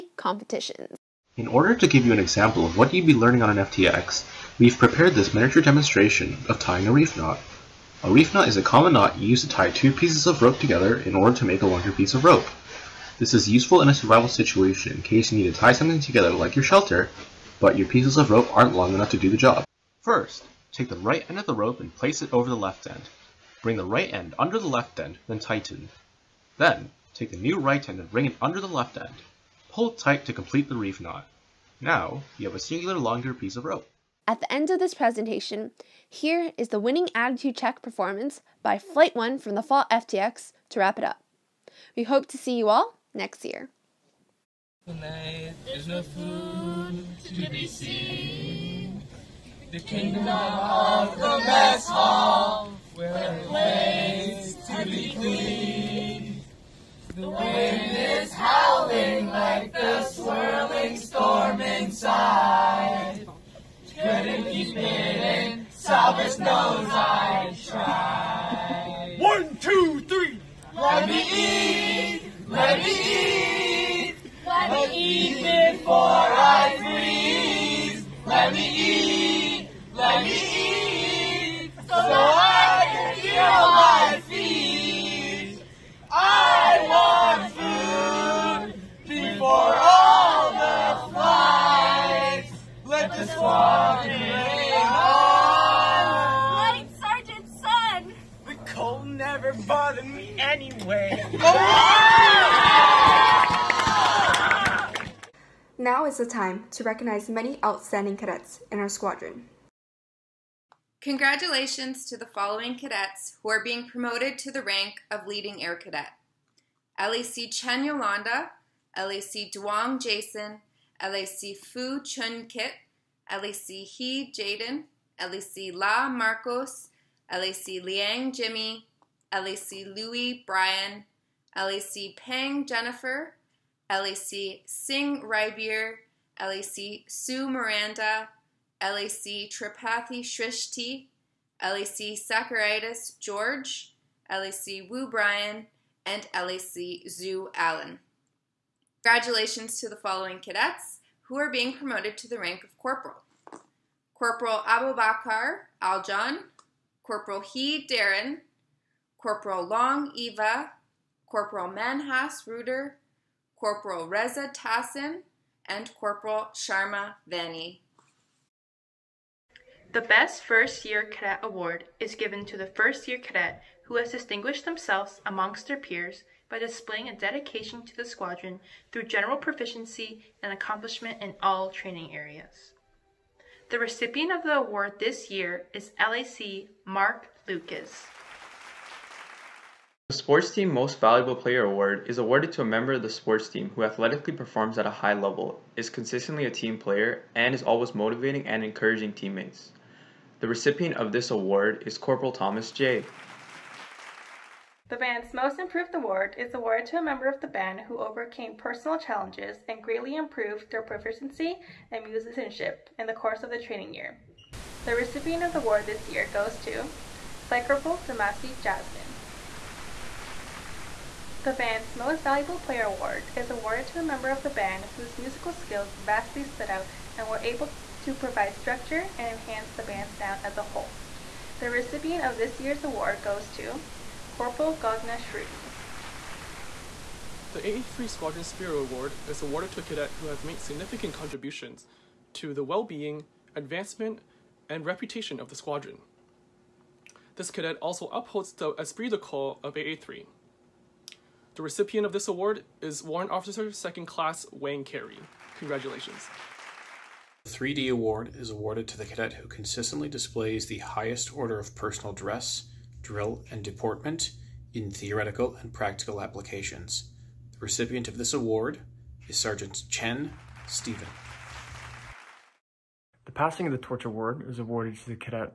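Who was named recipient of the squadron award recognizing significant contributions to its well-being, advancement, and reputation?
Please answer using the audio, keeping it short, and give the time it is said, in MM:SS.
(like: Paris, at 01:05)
Warrant Officer 2nd Class Wang Carey, at 04:13.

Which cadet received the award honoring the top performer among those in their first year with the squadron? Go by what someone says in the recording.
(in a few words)
LAC Mark Lucas.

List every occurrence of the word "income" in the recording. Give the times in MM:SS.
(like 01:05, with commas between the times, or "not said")
not said.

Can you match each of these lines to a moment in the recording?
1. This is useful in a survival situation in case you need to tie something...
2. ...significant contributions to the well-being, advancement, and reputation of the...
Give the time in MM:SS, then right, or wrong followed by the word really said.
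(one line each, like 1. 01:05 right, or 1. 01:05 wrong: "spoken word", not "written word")
1. 00:13 right
2. 04:00 right.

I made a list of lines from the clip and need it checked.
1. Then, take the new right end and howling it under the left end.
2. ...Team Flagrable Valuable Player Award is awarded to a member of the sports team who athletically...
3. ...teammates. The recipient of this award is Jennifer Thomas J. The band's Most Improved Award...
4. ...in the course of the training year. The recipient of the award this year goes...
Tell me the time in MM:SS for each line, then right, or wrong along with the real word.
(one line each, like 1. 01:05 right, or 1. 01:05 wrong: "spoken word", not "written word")
1. 00:26 wrong: "bring", not "howling"
2. 03:10 wrong: "Most", not "Flagrable"
3. 03:19 wrong: "Corporal", not "Jennifer"
4. 03:32 right.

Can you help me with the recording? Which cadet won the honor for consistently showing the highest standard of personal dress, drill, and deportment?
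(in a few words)
Sergeant Chen Stephen.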